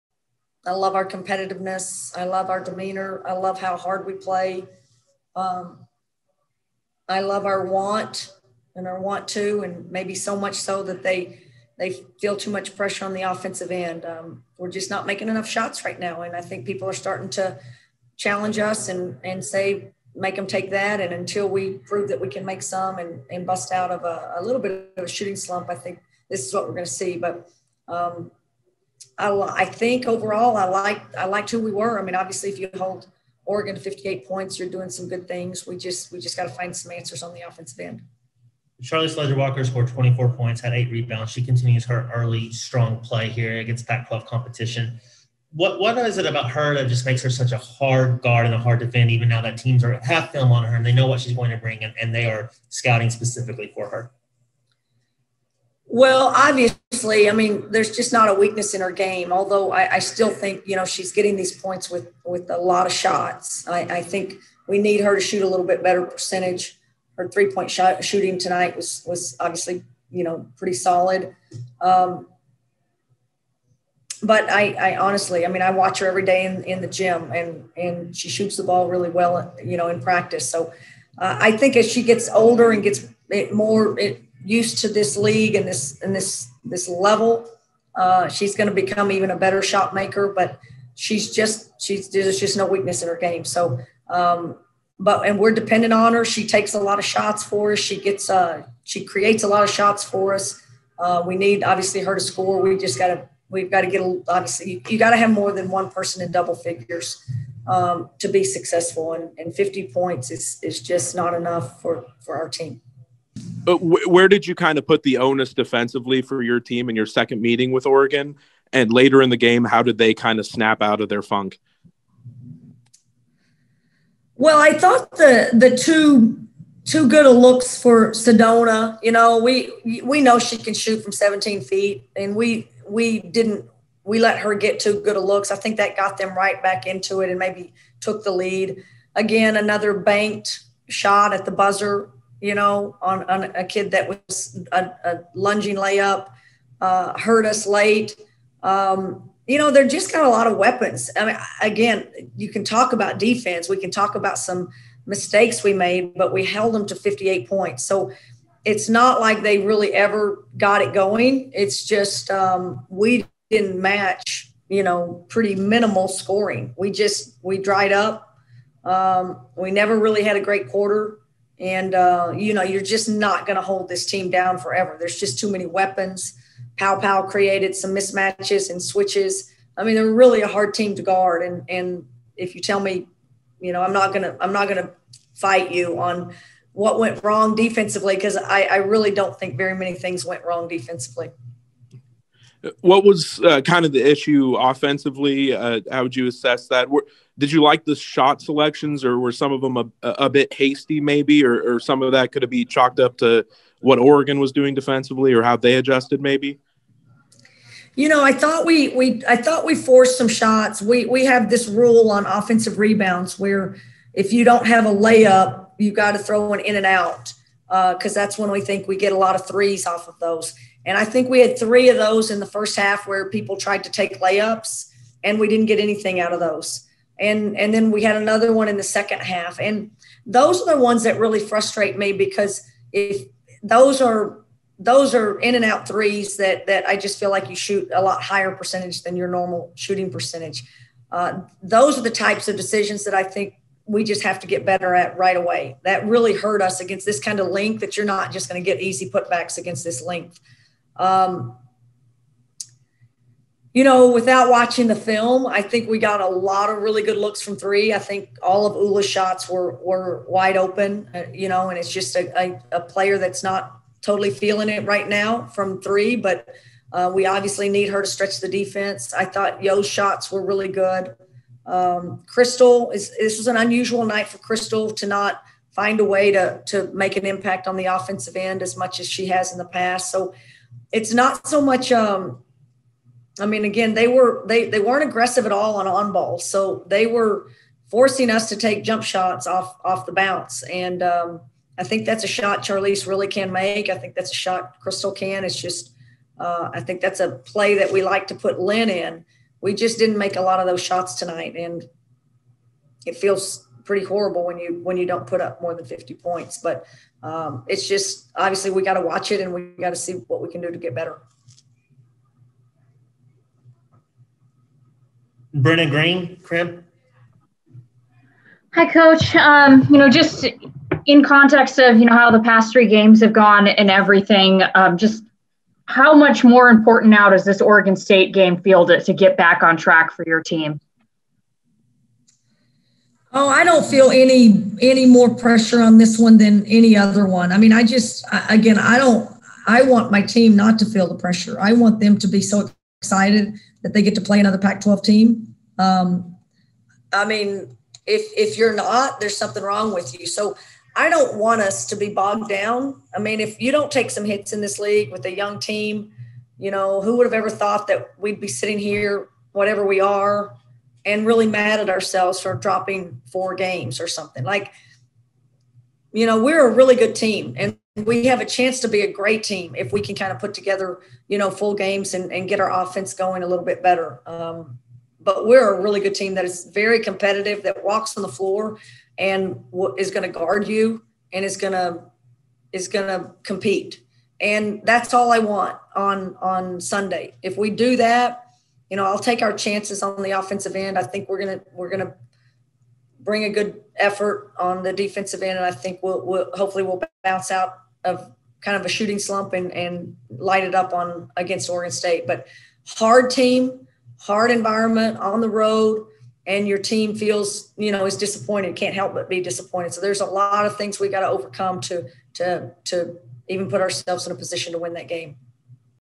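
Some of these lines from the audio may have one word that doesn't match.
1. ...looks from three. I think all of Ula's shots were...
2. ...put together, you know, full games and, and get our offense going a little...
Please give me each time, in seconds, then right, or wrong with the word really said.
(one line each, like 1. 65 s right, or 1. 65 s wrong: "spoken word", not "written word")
1. 257 s right
2. 370 s right.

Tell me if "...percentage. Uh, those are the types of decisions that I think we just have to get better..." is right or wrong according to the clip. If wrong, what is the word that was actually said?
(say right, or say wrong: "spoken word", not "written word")
right.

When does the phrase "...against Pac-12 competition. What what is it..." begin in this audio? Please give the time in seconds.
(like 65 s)
43 s.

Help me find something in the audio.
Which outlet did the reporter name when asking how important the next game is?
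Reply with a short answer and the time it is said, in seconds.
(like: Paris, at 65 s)
KREM, at 316 s.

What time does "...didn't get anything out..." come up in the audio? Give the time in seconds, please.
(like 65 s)
225 s.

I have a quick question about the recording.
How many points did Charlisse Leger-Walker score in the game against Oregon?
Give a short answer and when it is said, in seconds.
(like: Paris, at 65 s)
24, at 39 s.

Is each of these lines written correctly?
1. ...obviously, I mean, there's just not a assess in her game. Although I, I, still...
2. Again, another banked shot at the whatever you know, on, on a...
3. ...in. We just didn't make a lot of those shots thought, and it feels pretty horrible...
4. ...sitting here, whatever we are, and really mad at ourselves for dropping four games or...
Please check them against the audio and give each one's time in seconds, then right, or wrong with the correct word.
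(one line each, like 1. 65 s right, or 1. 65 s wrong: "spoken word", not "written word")
1. 56 s wrong: "weakness", not "assess"
2. 139 s wrong: "buzzer", not "whatever"
3. 298 s wrong: "tonight", not "thought"
4. 358 s right.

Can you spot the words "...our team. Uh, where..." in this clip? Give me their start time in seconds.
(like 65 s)
112 s.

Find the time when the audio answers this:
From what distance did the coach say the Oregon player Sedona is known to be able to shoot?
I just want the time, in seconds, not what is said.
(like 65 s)
131 s.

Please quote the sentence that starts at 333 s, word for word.
Oh, I don't feel any any more pressure on this one than any other one.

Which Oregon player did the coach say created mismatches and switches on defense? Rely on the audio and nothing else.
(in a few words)
Paopao.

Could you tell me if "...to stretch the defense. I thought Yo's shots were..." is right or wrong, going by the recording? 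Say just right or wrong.
right.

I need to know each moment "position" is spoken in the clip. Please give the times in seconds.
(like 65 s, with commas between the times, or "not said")
414 s.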